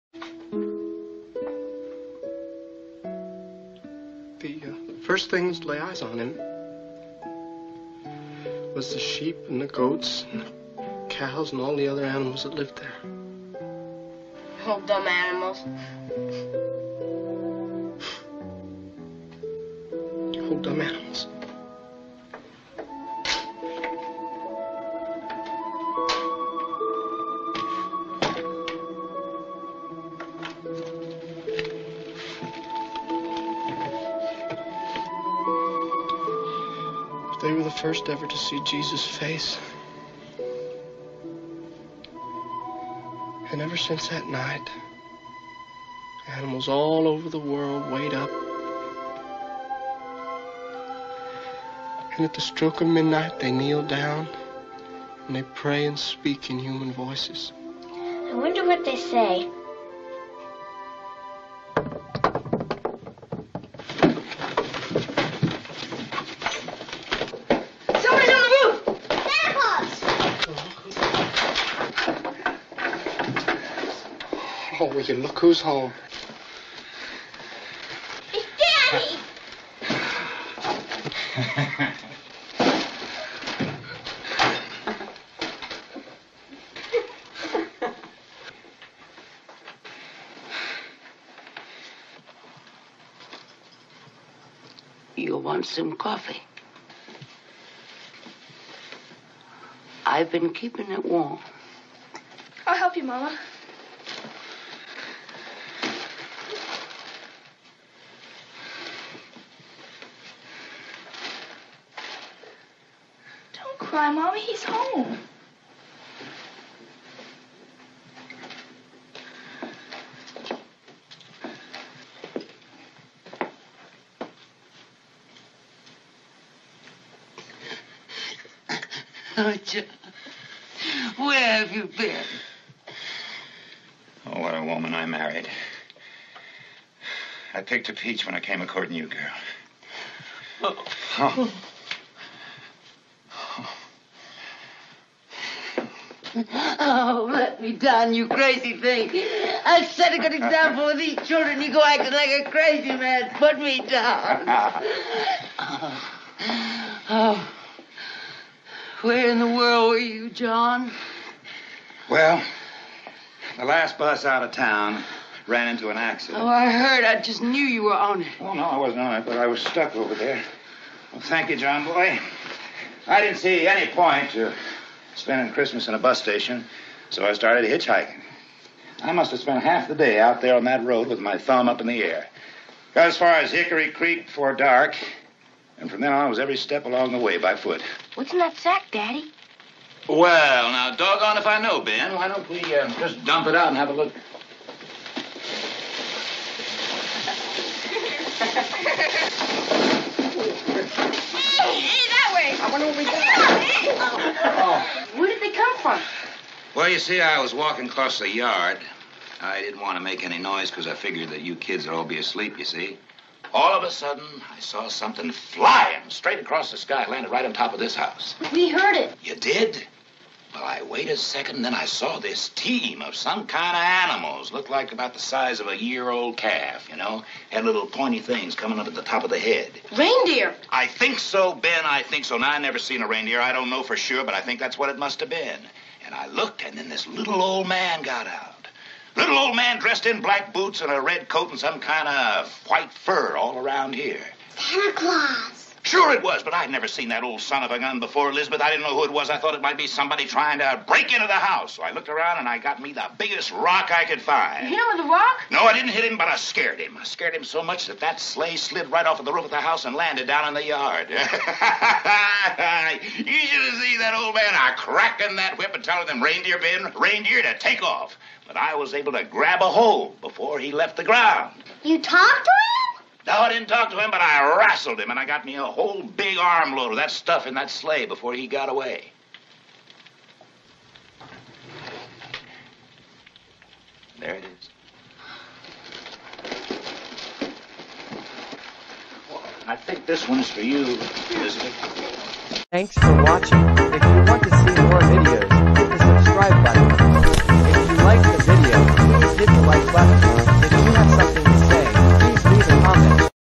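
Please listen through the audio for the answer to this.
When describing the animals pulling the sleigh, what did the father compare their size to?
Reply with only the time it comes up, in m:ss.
3:45.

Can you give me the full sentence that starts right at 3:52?
Now, i never seen a reindeer.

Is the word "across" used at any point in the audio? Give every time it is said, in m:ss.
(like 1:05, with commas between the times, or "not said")
3:27, 3:36.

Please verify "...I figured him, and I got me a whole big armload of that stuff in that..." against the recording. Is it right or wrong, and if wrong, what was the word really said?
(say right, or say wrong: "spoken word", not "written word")
wrong: "rassled", not "figured".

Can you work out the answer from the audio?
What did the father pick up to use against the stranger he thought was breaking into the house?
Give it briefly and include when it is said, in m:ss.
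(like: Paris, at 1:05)
The biggest rock, at 4:12.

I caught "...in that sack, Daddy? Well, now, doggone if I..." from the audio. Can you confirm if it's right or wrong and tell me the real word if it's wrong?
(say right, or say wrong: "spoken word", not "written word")
right.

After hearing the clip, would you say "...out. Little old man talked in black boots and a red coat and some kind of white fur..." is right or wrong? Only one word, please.
wrong.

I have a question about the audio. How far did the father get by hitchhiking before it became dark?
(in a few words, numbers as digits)
Hickory Creek.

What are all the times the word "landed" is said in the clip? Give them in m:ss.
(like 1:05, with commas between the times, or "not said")
3:37, 4:19.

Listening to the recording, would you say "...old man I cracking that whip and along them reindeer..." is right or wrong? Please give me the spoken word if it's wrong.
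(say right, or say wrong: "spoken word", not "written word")
wrong: "telling", not "along".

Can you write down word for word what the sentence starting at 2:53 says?
I didn't see any point to spending Christmas in a bus station, so I started hitchhiking.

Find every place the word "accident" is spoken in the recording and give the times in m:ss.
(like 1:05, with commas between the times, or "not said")
2:45.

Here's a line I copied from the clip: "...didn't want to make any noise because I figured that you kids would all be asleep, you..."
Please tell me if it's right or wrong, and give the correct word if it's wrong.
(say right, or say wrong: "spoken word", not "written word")
right.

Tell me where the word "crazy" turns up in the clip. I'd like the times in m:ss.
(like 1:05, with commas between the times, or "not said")
2:28, 2:32.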